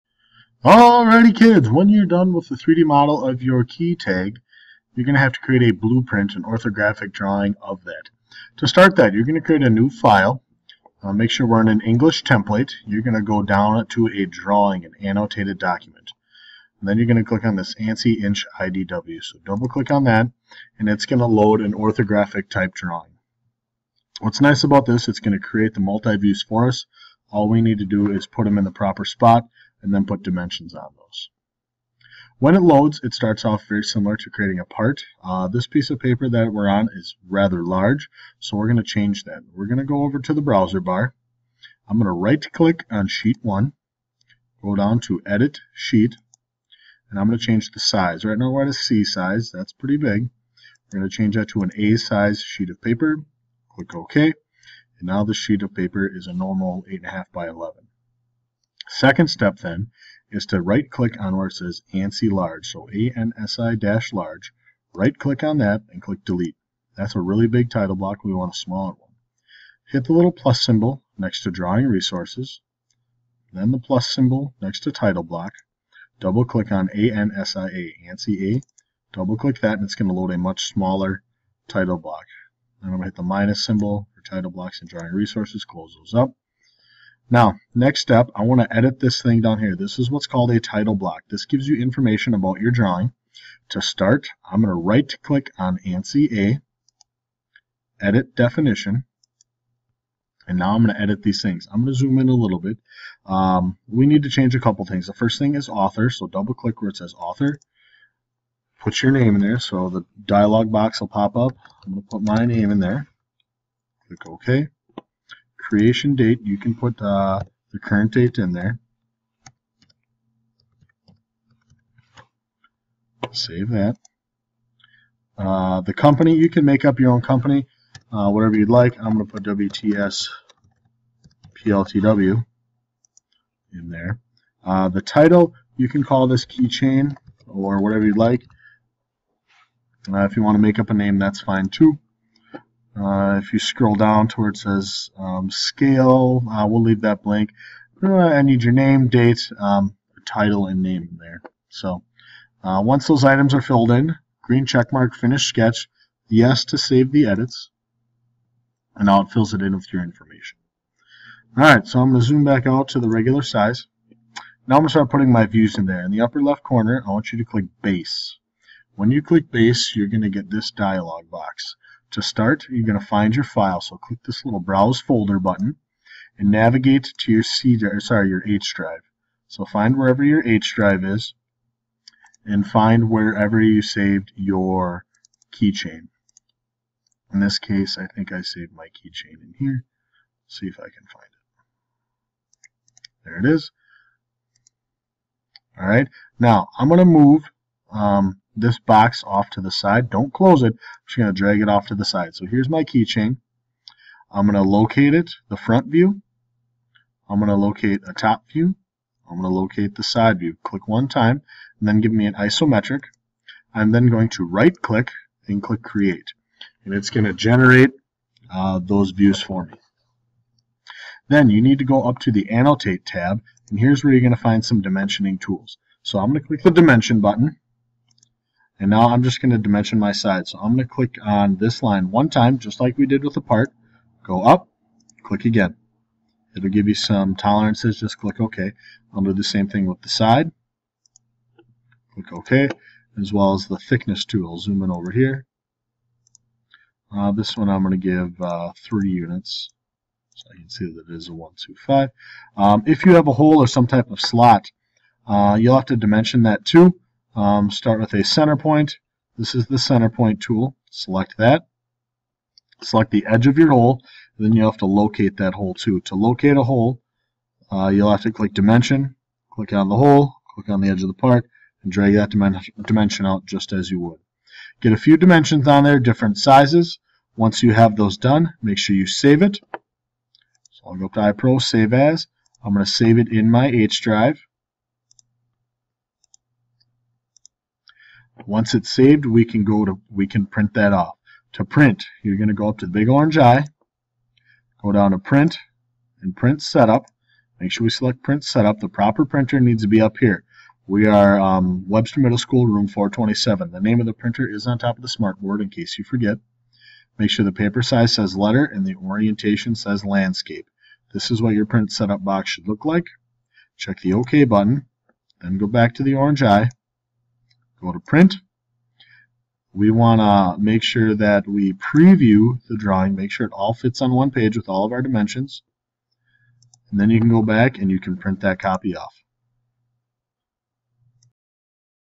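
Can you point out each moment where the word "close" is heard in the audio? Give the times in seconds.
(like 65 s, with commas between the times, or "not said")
85 s, 200 s.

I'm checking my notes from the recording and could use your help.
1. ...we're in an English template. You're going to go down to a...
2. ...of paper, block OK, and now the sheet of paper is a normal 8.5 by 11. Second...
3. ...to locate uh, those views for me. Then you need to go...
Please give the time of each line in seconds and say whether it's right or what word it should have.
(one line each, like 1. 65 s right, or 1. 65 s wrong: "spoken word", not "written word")
1. 11 s right
2. 52 s wrong: "click", not "block"
3. 217 s wrong: "generate", not "locate".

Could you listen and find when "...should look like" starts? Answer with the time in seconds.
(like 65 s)
312 s.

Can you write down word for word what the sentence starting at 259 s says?
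This is the center point tool.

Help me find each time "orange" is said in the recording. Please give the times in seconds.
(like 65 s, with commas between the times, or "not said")
293 s, 316 s.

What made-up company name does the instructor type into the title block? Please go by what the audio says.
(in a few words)
WTS PLTW.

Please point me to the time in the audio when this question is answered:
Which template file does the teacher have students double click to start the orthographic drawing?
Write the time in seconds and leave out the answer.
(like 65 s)
17 s.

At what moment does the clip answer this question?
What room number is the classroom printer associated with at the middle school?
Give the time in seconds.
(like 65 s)
302 s.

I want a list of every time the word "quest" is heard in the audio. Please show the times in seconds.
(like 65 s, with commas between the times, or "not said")
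not said.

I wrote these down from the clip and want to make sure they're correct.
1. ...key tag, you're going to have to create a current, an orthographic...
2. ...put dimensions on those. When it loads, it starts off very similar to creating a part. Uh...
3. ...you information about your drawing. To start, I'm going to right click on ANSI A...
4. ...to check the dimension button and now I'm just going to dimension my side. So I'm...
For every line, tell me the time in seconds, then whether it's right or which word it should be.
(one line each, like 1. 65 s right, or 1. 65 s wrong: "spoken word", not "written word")
1. 3 s wrong: "blueprint", not "current"
2. 30 s right
3. 91 s right
4. 226 s wrong: "click", not "check".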